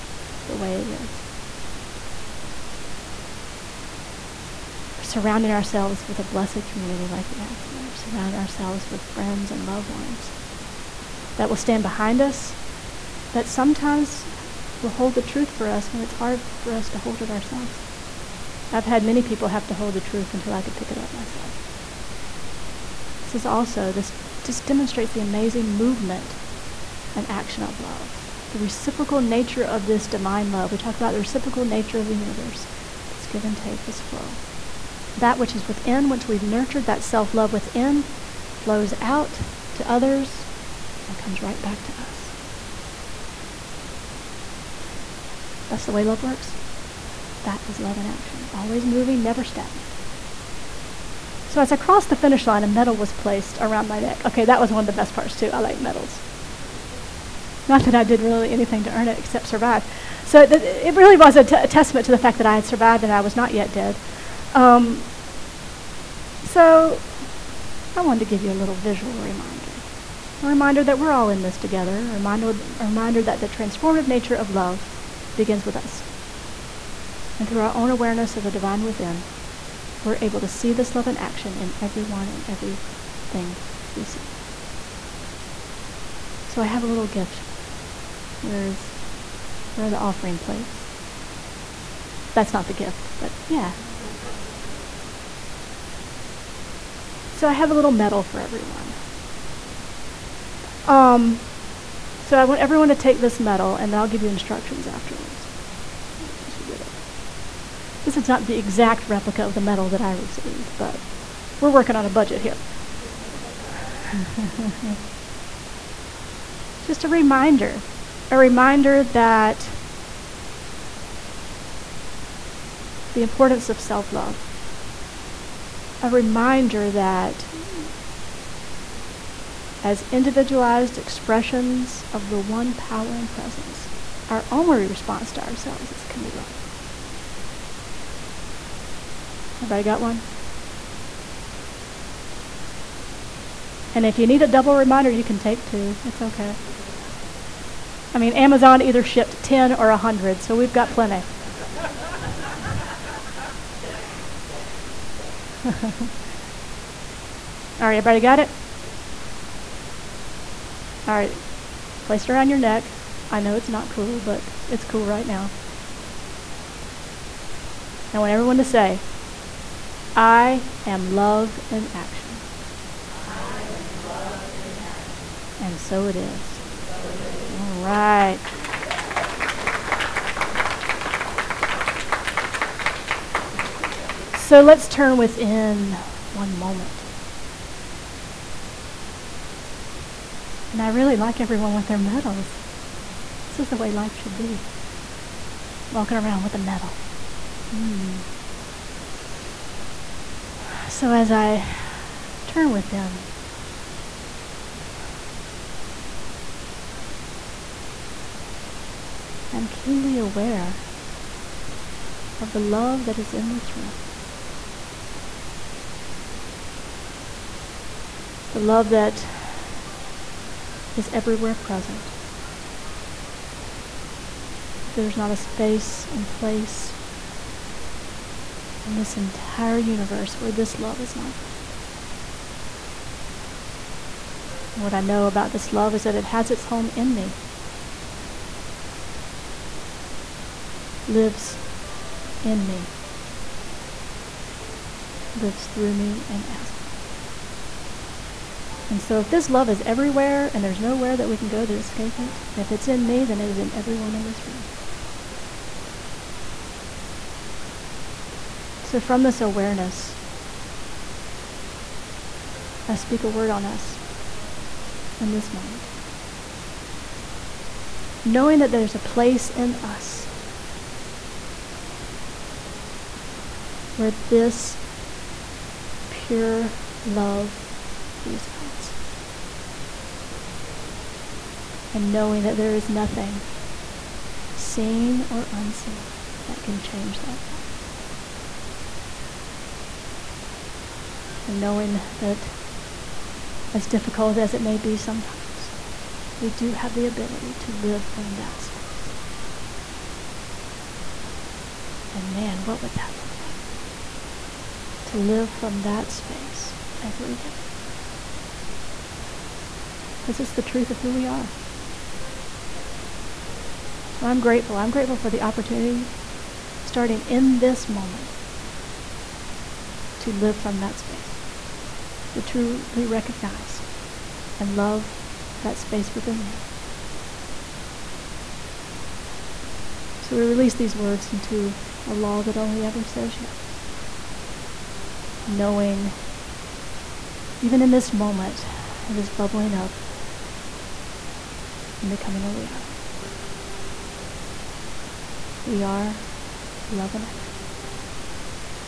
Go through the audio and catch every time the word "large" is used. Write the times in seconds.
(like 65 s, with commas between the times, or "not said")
not said.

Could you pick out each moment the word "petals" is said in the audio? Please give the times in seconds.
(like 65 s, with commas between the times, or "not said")
not said.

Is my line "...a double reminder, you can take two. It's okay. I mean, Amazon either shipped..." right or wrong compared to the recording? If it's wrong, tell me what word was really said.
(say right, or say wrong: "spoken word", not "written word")
right.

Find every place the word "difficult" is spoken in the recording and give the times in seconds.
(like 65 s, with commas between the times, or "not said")
293 s.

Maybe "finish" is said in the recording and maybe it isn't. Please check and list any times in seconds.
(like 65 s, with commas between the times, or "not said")
52 s.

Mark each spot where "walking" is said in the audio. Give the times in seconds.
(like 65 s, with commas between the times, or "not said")
195 s.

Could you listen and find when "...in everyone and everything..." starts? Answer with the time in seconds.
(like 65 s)
81 s.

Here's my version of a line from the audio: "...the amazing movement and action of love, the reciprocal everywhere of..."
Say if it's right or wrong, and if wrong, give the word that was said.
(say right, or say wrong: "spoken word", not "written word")
wrong: "nature", not "everywhere".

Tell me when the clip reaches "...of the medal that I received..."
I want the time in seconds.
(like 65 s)
109 s.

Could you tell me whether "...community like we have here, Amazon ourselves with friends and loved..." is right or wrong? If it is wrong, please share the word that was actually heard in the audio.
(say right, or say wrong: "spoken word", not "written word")
wrong: "Surrounding", not "Amazon".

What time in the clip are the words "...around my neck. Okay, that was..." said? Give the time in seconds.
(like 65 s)
53 s.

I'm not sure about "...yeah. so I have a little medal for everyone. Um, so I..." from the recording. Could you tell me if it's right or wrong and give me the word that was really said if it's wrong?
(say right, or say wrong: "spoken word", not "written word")
right.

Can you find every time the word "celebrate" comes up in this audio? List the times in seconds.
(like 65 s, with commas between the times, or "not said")
not said.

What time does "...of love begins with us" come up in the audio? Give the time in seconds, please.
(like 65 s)
74 s.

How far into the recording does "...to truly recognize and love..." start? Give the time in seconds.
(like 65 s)
322 s.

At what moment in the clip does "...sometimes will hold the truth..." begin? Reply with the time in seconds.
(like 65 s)
13 s.